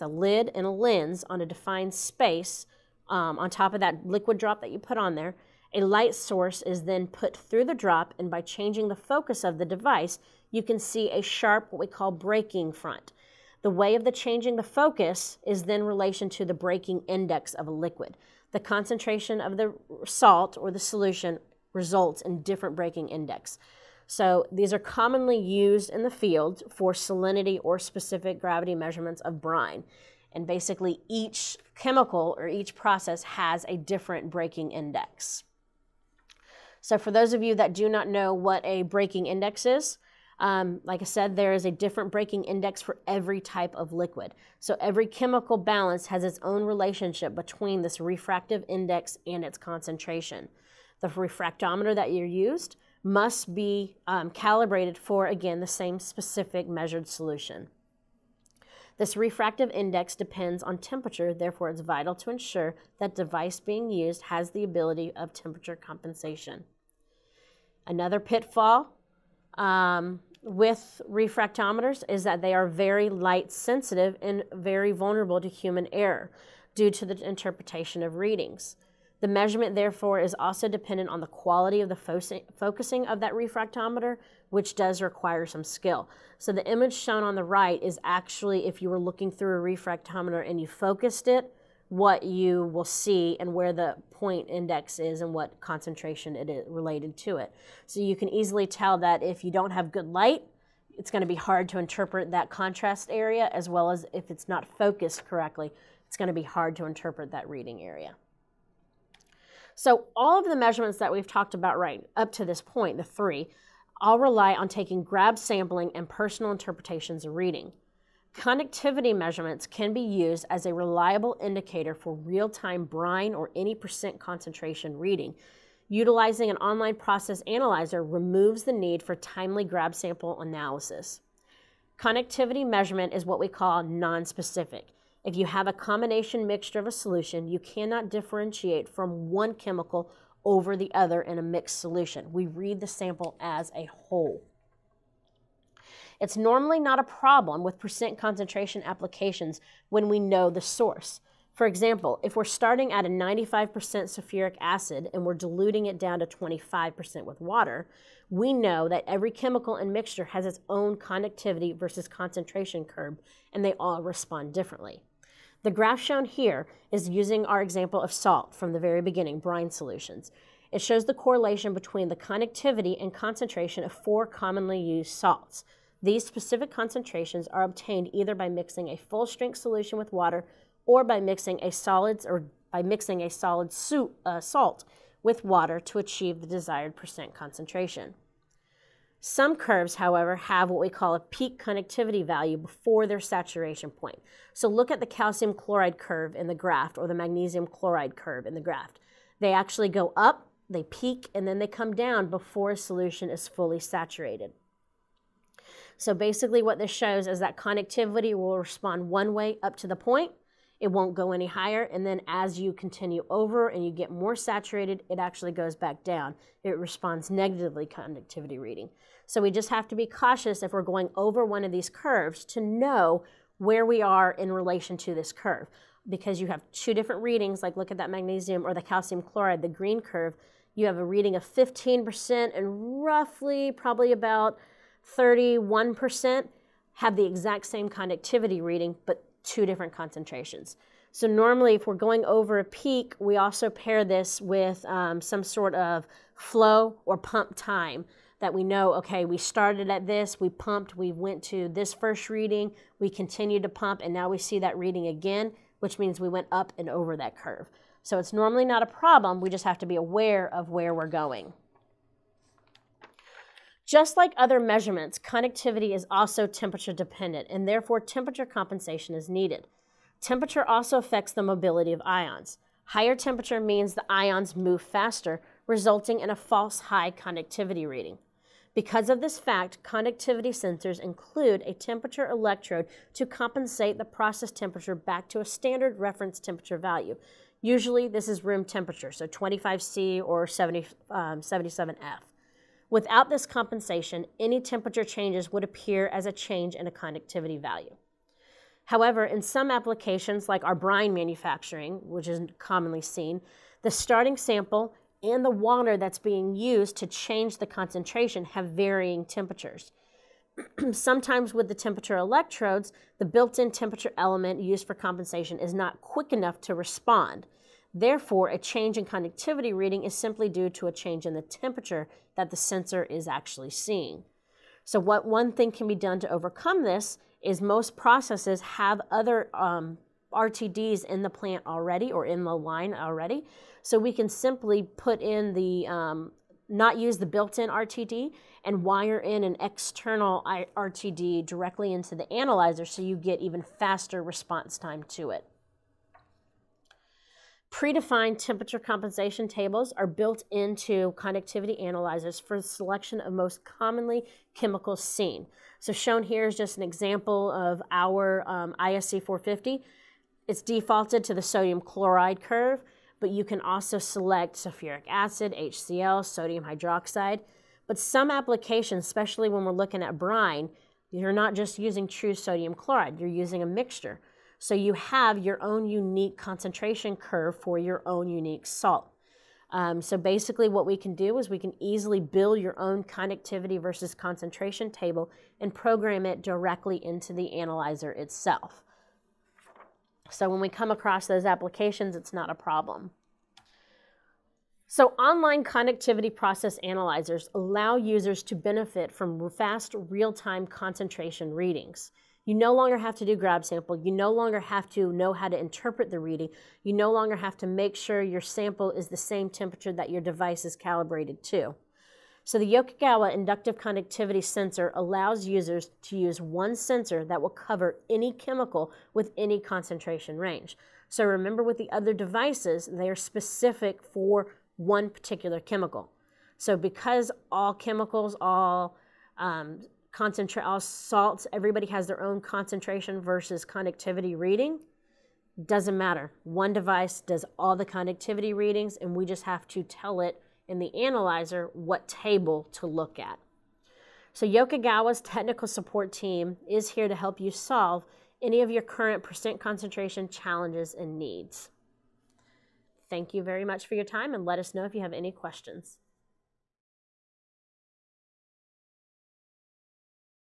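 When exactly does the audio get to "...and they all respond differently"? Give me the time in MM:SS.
02:43.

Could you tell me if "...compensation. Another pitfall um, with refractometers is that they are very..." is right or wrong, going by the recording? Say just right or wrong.
right.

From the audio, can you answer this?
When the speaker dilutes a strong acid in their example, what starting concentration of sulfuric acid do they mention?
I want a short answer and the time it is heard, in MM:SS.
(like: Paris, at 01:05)
95%, at 02:33.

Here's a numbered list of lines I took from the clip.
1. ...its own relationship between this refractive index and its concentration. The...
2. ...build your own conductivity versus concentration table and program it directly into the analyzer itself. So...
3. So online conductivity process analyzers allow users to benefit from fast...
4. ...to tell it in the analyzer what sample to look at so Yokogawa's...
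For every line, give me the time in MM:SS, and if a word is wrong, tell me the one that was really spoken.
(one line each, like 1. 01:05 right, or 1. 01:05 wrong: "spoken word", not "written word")
1. 00:46 right
2. 06:22 right
3. 06:34 right
4. 07:19 wrong: "table", not "sample".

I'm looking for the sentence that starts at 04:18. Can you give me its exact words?
So it's normally not a problem, we just have to be aware of where we're going.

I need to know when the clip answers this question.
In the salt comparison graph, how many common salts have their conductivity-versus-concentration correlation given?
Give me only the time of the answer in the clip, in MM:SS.
02:53.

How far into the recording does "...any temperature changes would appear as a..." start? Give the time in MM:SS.
04:54.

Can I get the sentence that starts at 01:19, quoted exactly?
The measurement, therefore, is also dependent on the quality of the fo focusing of that refractometer, which does require some skill.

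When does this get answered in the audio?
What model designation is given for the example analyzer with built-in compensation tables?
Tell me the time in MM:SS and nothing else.
05:58.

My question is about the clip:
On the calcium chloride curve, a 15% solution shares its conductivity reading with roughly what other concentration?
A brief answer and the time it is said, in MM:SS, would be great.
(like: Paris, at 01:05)
31%, at 03:55.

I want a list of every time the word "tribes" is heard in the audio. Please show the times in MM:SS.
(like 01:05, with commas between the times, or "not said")
not said.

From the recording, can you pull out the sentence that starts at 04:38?
Because of this fact, conductivity sensors include a temperature electrode to compensate the process temperature back to a standard reference temperature value.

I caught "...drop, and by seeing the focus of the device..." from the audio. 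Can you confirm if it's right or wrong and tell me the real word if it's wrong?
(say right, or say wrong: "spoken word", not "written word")
wrong: "changing", not "seeing".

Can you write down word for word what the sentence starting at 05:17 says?
Therefore, a change in conductivity reading is simply due to a change in the temperature that the sensor is actually seeing.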